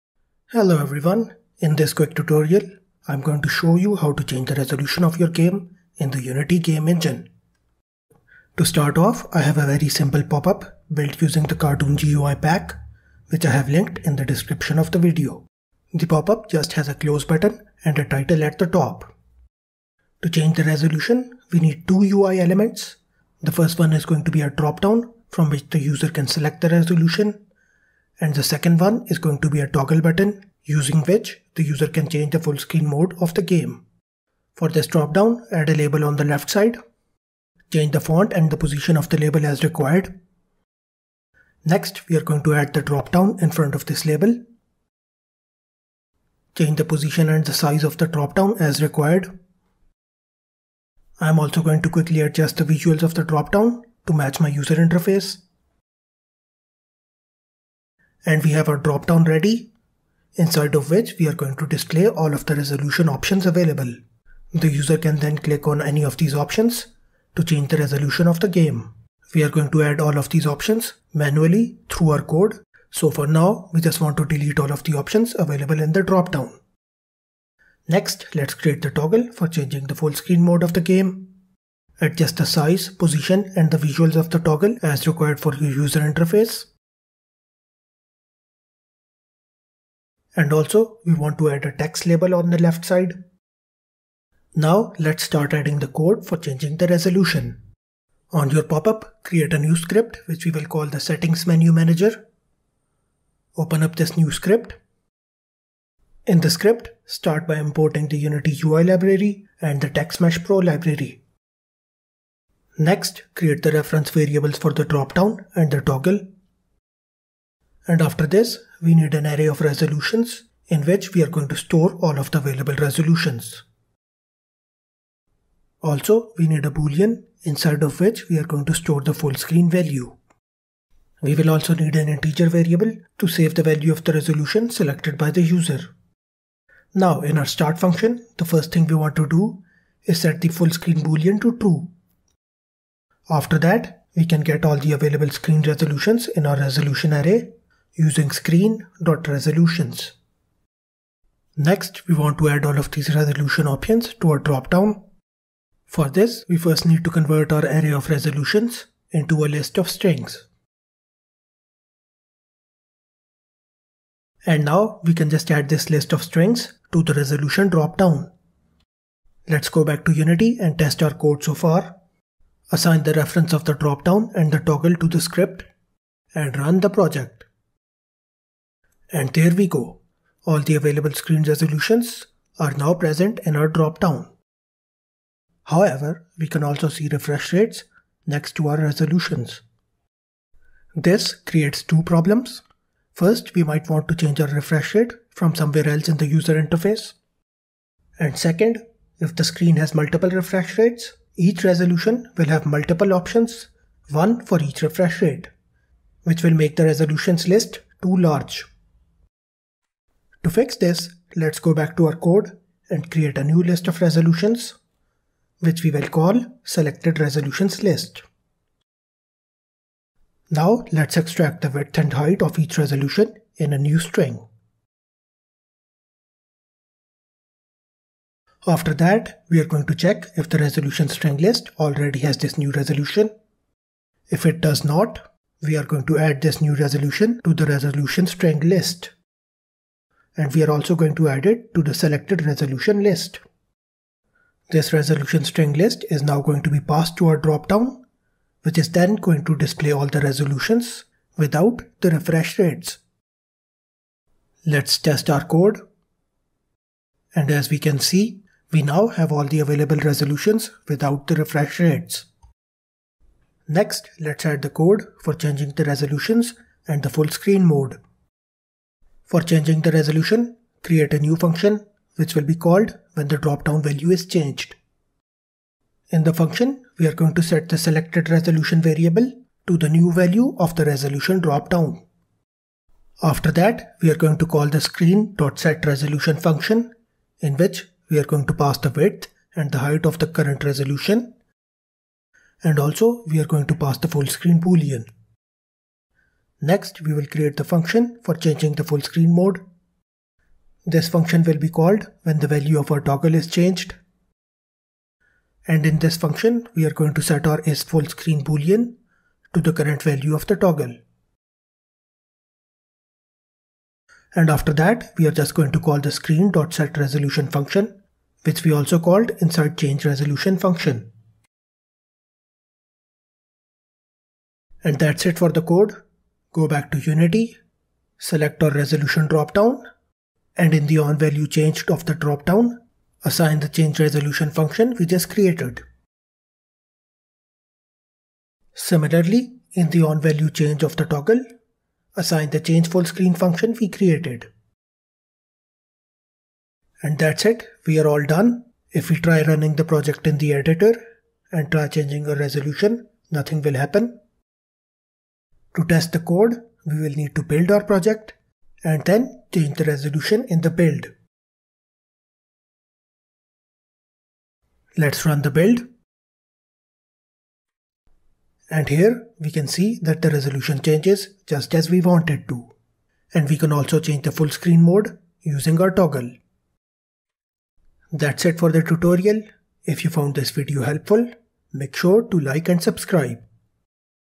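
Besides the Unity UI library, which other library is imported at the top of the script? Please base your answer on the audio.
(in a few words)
TextMesh Pro.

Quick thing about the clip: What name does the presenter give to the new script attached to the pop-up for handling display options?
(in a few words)
settings menu manager.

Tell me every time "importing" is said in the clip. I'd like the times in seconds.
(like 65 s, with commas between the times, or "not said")
107 s.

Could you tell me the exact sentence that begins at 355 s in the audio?
To test the code, we will need to build our project and then change the resolution in the build.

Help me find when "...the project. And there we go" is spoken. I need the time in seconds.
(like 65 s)
176 s.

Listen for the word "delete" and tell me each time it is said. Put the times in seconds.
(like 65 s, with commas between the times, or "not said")
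74 s.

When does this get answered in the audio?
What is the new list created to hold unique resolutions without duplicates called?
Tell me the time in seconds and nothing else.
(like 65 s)
216 s.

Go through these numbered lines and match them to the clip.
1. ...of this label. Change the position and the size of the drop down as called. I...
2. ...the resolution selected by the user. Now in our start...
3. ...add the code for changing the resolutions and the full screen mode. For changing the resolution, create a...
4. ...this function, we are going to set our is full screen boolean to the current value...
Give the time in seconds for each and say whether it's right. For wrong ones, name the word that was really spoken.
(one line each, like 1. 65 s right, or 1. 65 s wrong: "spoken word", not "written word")
1. 43 s wrong: "required", not "called"
2. 134 s right
3. 264 s right
4. 305 s right.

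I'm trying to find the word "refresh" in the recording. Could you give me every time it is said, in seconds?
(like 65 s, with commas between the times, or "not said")
187 s, 194 s, 200 s, 204 s, 252 s, 261 s.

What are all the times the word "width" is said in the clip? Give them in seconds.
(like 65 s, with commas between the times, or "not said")
221 s, 288 s.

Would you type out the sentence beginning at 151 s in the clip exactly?
Next, we want to add all of these resolution options to a dropdown.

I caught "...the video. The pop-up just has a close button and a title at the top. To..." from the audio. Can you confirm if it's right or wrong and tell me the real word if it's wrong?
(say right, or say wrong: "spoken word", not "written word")
right.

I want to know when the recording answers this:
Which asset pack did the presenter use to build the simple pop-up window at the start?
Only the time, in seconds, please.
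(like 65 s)
11 s.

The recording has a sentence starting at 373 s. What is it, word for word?
And we can also change the full screen mode using our toggle.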